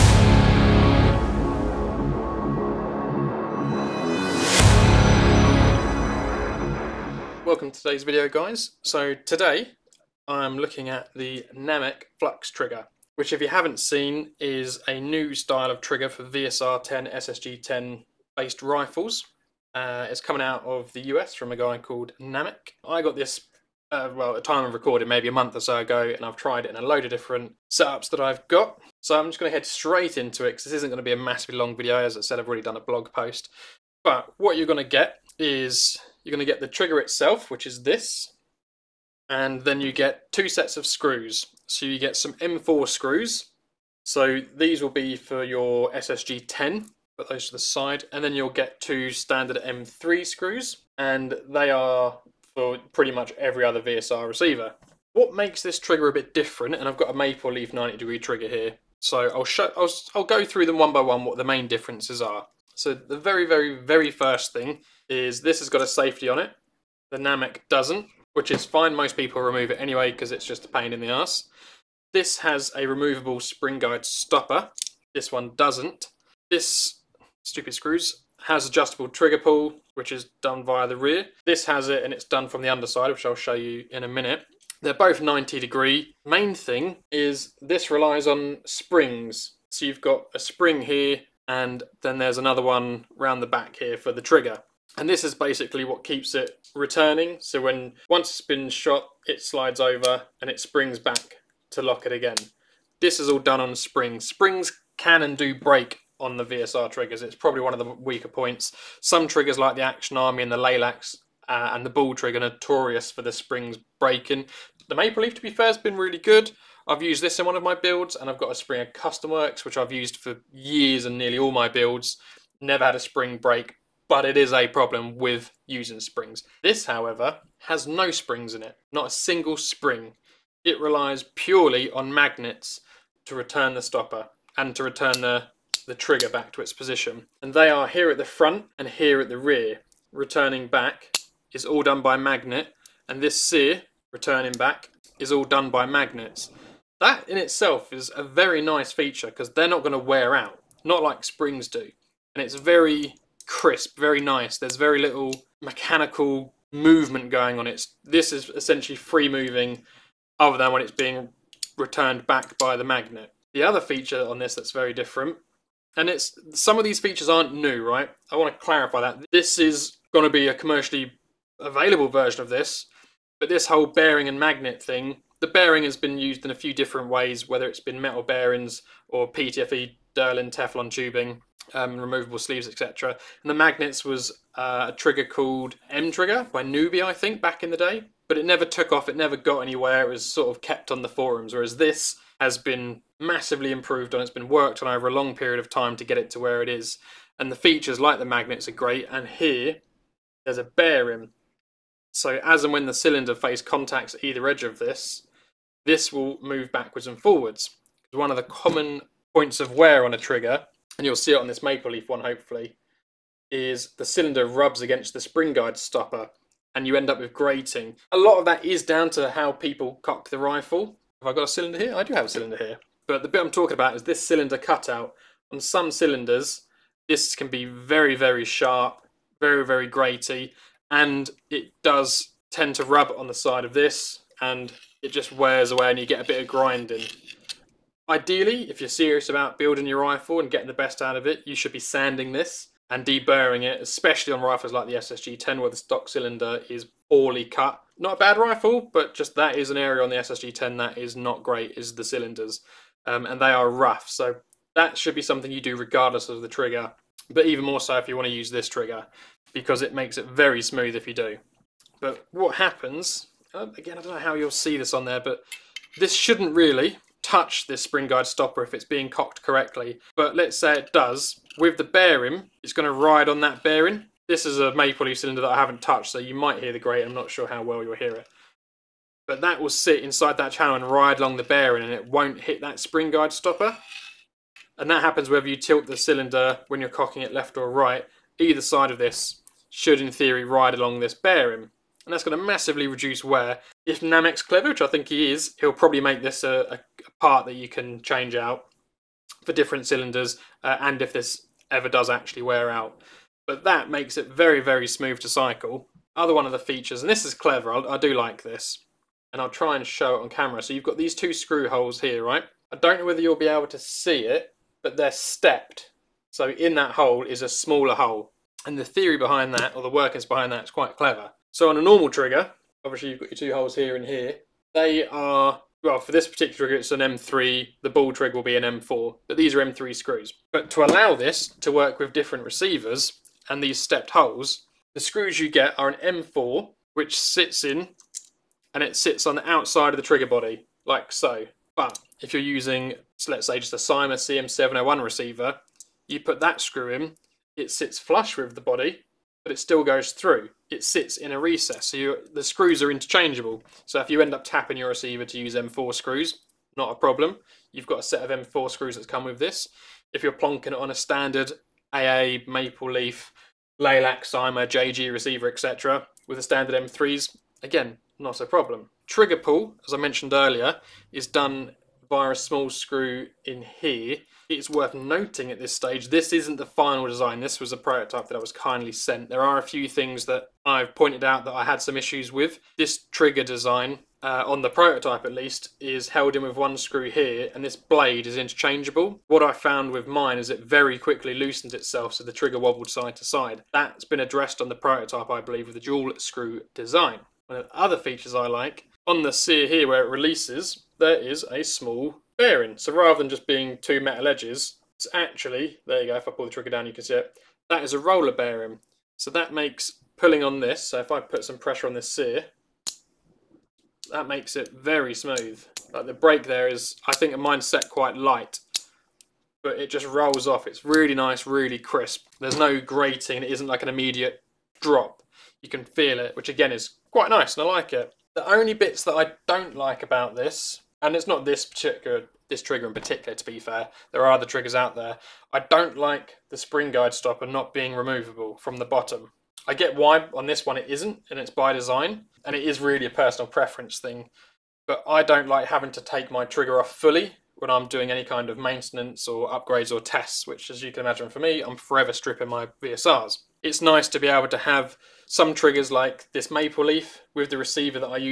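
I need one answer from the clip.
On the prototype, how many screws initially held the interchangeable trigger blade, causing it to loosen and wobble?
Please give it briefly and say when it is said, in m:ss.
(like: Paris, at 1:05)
1, at 6:26.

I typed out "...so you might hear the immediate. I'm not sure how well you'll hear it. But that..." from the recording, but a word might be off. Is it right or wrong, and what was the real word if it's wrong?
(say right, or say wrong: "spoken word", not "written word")
wrong: "grate", not "immediate".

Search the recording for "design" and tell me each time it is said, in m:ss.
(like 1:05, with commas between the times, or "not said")
6:17, 6:23, 6:36, 7:21.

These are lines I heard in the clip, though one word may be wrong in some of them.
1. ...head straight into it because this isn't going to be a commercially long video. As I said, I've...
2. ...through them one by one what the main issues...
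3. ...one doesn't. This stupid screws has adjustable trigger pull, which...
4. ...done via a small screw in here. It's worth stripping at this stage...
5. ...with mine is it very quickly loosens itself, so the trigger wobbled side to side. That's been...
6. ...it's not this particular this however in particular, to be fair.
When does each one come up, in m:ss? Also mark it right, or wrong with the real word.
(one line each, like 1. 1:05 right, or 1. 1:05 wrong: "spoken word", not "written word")
1. 0:29 wrong: "massively", not "commercially"
2. 1:00 wrong: "differences", not "issues"
3. 1:15 right
4. 6:11 wrong: "noting", not "stripping"
5. 6:29 right
6. 7:11 wrong: "trigger", not "however".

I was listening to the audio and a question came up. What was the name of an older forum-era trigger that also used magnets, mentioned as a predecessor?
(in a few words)
M Trigger.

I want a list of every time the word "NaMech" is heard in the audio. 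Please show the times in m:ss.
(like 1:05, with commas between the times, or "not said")
0:11, 0:22, 1:07, 4:53.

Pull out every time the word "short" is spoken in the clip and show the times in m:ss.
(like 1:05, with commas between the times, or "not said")
not said.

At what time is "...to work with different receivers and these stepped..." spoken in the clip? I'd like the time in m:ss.
5:31.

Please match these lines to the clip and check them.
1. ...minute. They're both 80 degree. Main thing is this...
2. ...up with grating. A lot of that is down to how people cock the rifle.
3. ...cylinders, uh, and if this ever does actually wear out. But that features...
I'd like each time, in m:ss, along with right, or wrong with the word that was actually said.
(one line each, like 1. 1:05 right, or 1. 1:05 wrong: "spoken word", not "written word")
1. 1:24 wrong: "90", not "80"
2. 3:37 right
3. 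4:59 wrong: "makes", not "features".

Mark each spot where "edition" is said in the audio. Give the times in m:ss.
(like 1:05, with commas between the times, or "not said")
not said.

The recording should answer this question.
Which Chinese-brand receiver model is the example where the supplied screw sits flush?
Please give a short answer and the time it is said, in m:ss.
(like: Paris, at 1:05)
CYMA CM701, at 5:43.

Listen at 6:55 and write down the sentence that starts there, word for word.
Like the brake there is, I think mine's set quite light, but it just rolls off.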